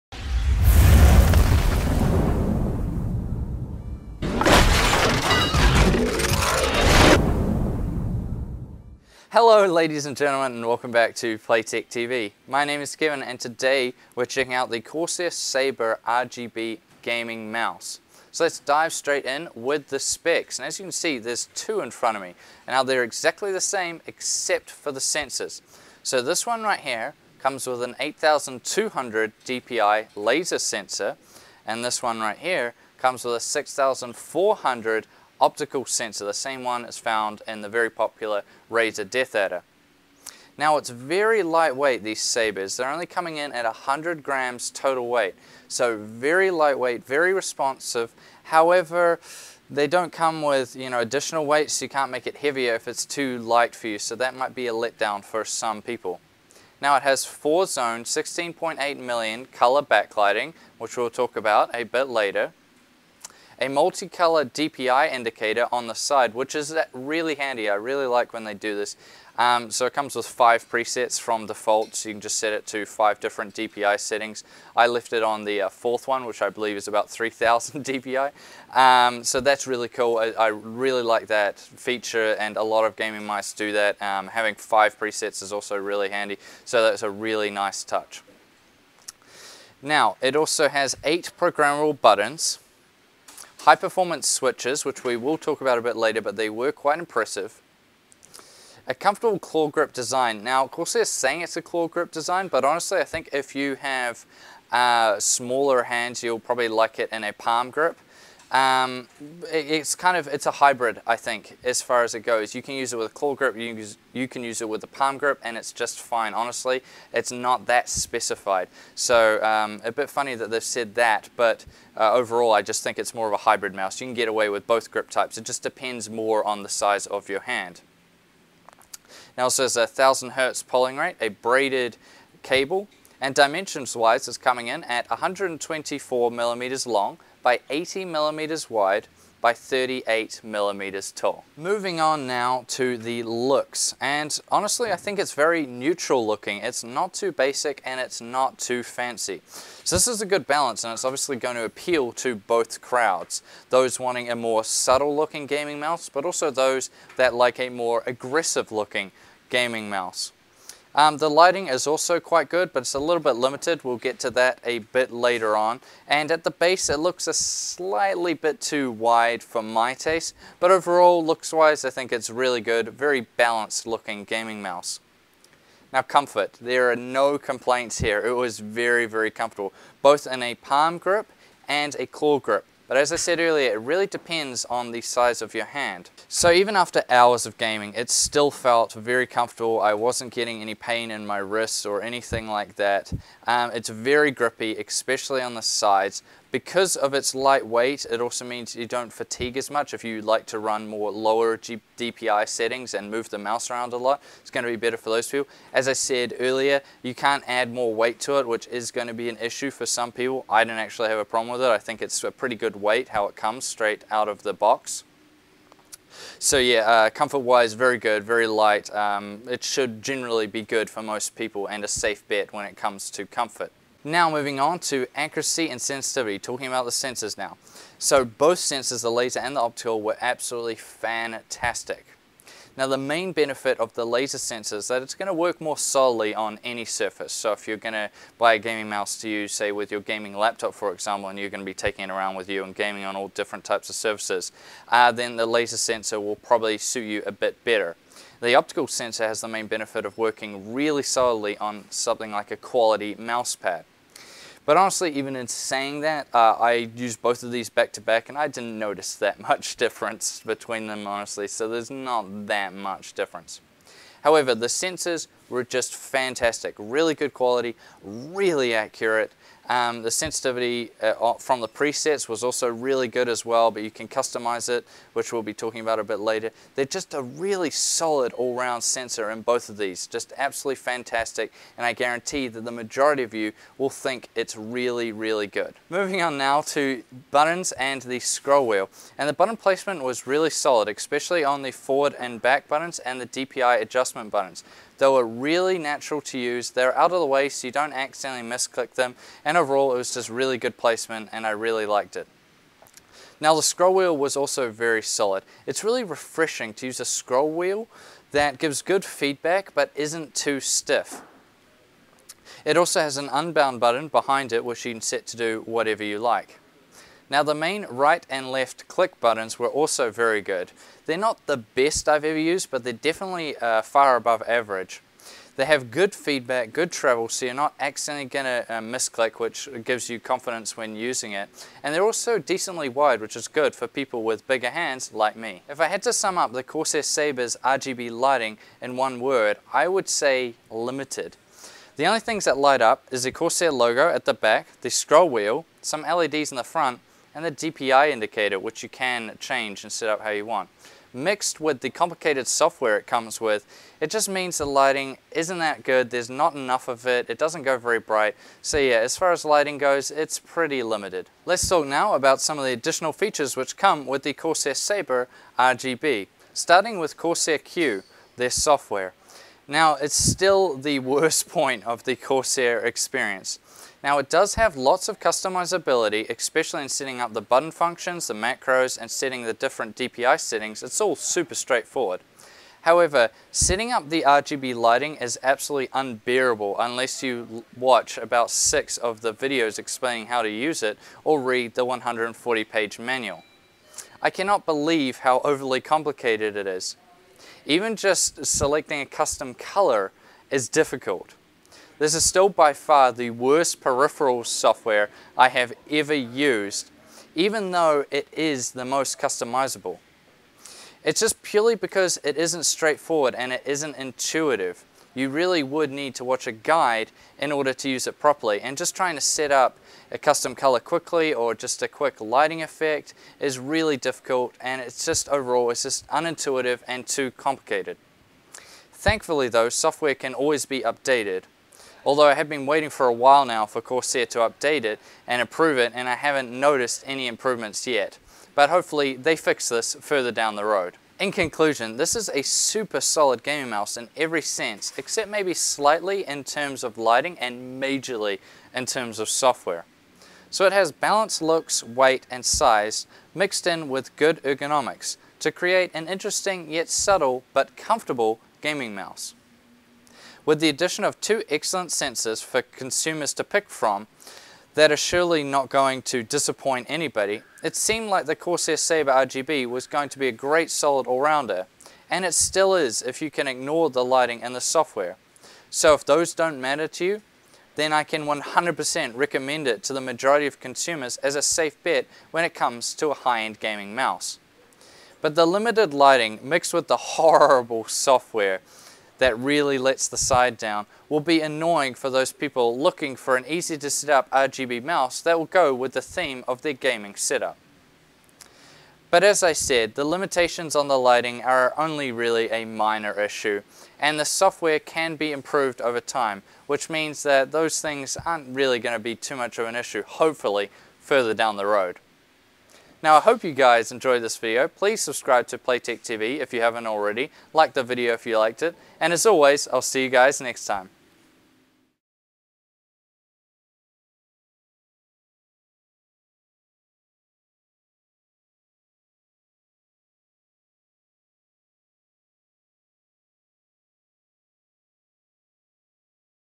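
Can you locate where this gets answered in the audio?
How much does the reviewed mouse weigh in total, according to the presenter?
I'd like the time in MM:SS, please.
00:43.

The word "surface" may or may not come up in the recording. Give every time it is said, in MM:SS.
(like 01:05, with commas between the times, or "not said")
03:56, 04:03.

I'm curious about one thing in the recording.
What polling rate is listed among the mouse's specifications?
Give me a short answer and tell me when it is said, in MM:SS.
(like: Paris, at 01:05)
1000 hertz, at 02:09.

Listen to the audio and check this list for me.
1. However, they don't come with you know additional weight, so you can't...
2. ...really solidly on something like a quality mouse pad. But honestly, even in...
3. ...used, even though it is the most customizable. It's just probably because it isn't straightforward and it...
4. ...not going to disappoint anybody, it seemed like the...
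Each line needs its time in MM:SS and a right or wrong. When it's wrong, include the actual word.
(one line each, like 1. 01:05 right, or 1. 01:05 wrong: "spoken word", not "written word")
1. 00:48 right
2. 04:10 right
3. 06:46 wrong: "purely", not "probably"
4. 07:45 right.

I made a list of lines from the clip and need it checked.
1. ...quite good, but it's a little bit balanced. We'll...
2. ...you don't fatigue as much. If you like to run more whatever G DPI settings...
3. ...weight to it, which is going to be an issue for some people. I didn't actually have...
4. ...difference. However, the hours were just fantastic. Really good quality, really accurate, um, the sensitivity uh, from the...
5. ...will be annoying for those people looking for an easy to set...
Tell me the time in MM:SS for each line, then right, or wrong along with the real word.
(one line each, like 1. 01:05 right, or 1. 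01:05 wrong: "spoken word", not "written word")
1. 02:42 wrong: "limited", not "balanced"
2. 03:18 wrong: "lower", not "whatever"
3. 03:27 right
4. 04:23 wrong: "sensors", not "hours"
5. 08:11 right.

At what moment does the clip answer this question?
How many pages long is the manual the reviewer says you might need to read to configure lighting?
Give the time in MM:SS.
06:31.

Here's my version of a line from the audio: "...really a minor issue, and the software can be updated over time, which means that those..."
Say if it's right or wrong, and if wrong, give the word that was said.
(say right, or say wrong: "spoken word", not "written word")
wrong: "improved", not "updated".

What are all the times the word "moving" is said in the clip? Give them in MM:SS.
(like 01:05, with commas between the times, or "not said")
02:21, 03:44, 04:45.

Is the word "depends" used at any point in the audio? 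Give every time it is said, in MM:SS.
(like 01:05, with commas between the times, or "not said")
02:05, 03:04.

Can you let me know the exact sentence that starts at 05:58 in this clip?
So yeah, as far as lighting goes, it's pretty limited.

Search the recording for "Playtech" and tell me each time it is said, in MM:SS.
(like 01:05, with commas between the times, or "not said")
00:11, 08:35.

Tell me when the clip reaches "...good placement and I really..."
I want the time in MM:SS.
05:00.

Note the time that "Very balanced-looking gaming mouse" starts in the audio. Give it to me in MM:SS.
02:52.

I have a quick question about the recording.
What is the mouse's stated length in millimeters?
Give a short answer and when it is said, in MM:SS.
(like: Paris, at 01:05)
124 millimeters, at 02:15.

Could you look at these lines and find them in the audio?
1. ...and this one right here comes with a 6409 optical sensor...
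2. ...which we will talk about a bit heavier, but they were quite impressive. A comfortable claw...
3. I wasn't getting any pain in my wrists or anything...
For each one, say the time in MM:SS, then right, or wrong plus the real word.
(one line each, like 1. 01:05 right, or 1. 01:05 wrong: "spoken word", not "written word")
1. 00:31 wrong: "6400", not "6409"
2. 01:34 wrong: "later", not "heavier"
3. 03:09 right.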